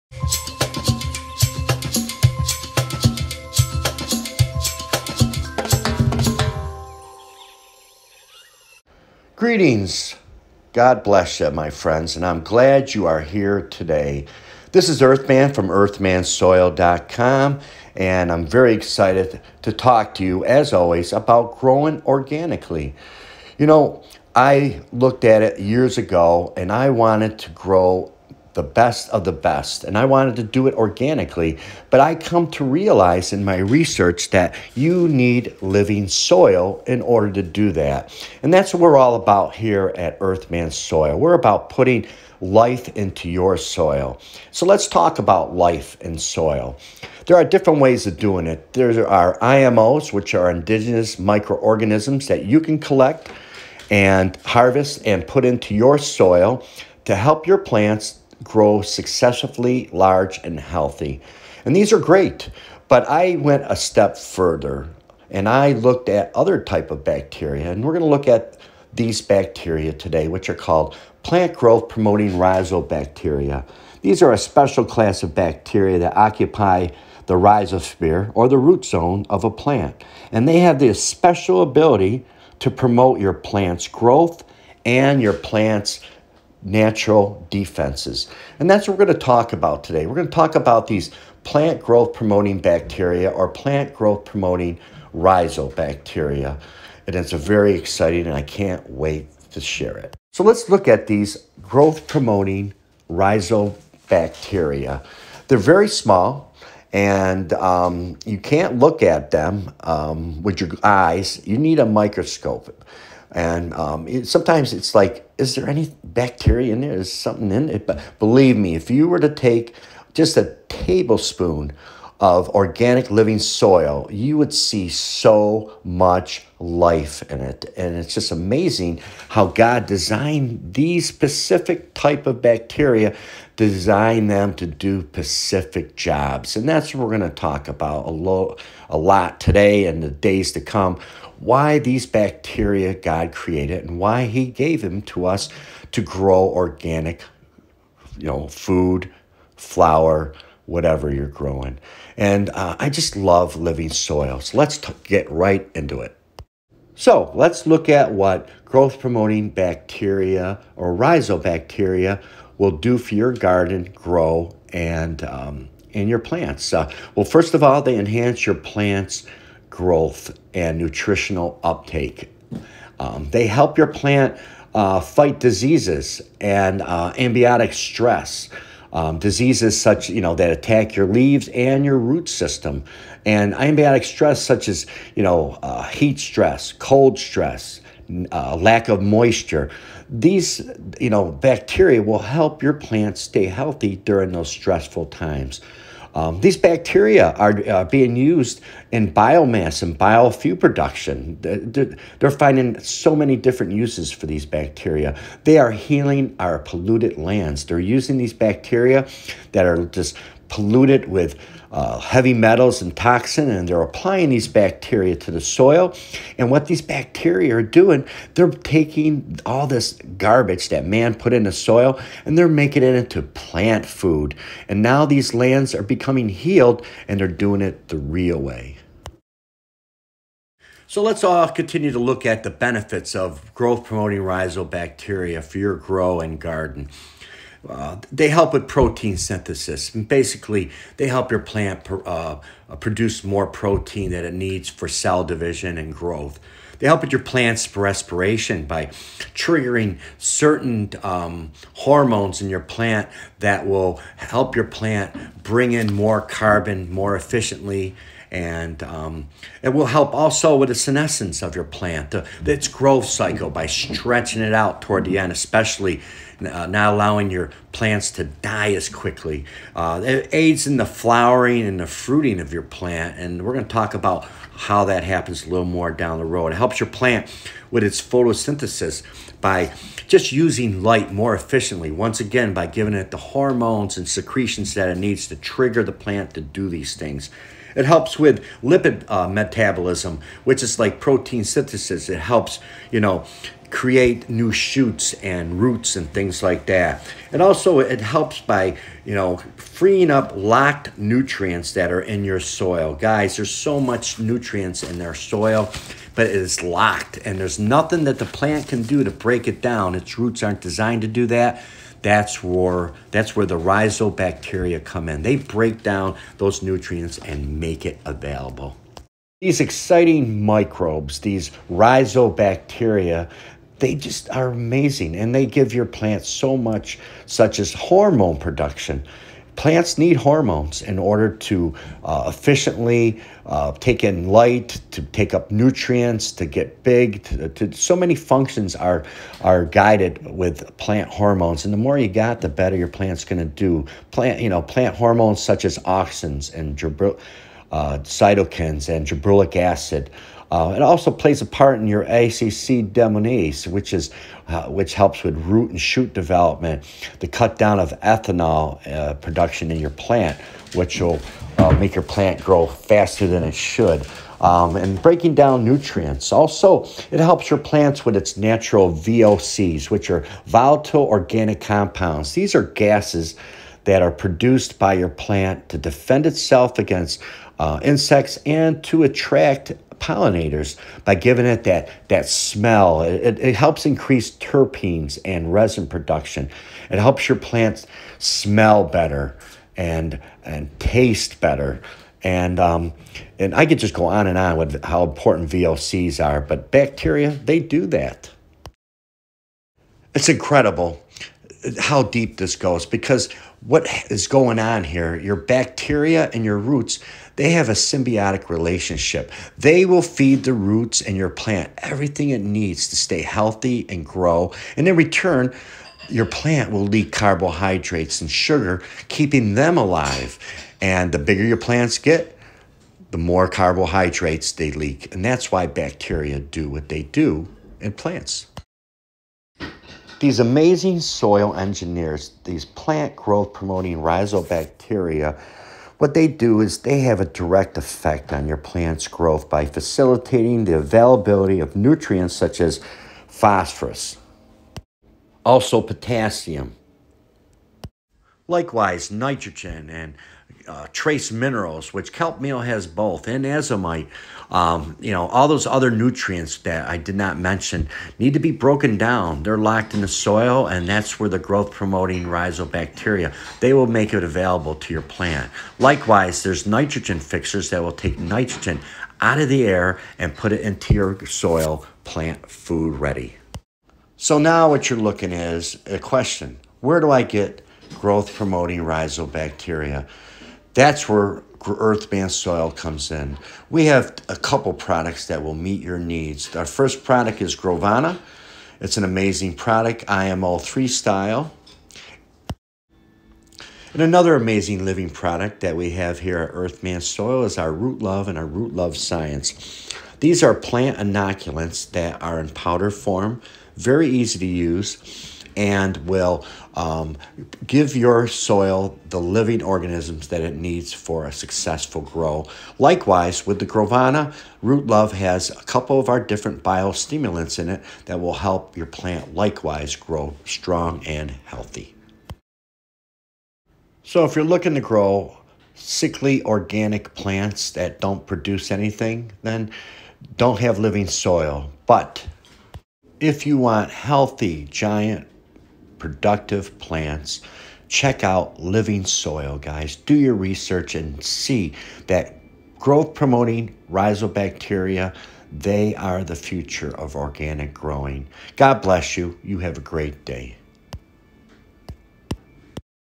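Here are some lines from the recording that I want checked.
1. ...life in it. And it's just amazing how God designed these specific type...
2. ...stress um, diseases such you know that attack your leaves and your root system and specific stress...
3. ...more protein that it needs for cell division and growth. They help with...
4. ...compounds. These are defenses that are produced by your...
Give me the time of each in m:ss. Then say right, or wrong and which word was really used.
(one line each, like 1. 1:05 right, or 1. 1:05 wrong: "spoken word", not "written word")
1. 2:06 right
2. 2:57 wrong: "abiotic", not "specific"
3. 4:03 right
4. 6:11 wrong: "gases", not "defenses".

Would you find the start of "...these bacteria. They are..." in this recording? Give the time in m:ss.
3:24.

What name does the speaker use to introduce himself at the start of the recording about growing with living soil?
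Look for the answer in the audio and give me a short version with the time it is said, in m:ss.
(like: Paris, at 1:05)
Earthman, at 0:15.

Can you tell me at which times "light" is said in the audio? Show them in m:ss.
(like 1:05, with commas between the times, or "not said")
4:40, 5:34.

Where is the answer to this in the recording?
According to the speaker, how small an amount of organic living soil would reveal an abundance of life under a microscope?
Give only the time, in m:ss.
2:00.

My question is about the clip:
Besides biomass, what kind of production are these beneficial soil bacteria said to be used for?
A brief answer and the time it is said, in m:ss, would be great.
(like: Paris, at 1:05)
biofuel, at 3:19.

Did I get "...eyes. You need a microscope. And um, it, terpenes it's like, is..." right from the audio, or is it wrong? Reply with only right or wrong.
wrong.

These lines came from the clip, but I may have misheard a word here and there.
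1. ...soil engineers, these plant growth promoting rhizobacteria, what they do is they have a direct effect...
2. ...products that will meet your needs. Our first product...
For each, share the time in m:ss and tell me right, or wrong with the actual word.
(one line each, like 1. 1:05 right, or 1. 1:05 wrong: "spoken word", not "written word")
1. 7:10 right
2. 8:04 right.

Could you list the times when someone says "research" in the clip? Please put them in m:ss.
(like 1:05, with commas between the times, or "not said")
0:33, 9:00.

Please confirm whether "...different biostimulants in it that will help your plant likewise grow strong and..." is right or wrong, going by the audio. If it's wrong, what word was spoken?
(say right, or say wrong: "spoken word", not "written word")
right.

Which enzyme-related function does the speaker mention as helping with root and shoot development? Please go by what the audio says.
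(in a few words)
ACC deaminase.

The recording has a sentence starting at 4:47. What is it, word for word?
It helps with lipid uh, metabolism, which is like protein synthesis.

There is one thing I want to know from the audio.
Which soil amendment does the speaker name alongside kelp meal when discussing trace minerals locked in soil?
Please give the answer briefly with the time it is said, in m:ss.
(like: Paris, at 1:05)
azomite, at 7:33.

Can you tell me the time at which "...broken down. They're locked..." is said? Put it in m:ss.
7:38.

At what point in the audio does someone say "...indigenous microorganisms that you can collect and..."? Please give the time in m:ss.
0:50.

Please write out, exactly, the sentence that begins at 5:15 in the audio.
They break down those nutrients and make it available.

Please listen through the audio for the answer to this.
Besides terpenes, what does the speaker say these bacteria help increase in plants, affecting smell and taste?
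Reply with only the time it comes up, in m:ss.
6:25.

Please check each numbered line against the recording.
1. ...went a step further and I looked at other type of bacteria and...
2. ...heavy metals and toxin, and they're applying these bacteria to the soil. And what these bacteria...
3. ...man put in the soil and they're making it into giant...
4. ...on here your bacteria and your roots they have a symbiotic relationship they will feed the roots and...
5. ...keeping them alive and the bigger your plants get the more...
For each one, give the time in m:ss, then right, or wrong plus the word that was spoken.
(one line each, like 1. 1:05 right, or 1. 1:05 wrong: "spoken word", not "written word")
1. 1:03 right
2. 3:31 right
3. 3:40 wrong: "plant", not "giant"
4. 6:44 right
5. 6:59 right.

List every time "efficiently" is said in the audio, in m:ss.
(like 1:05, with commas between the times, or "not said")
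4:17, 4:41, 5:32.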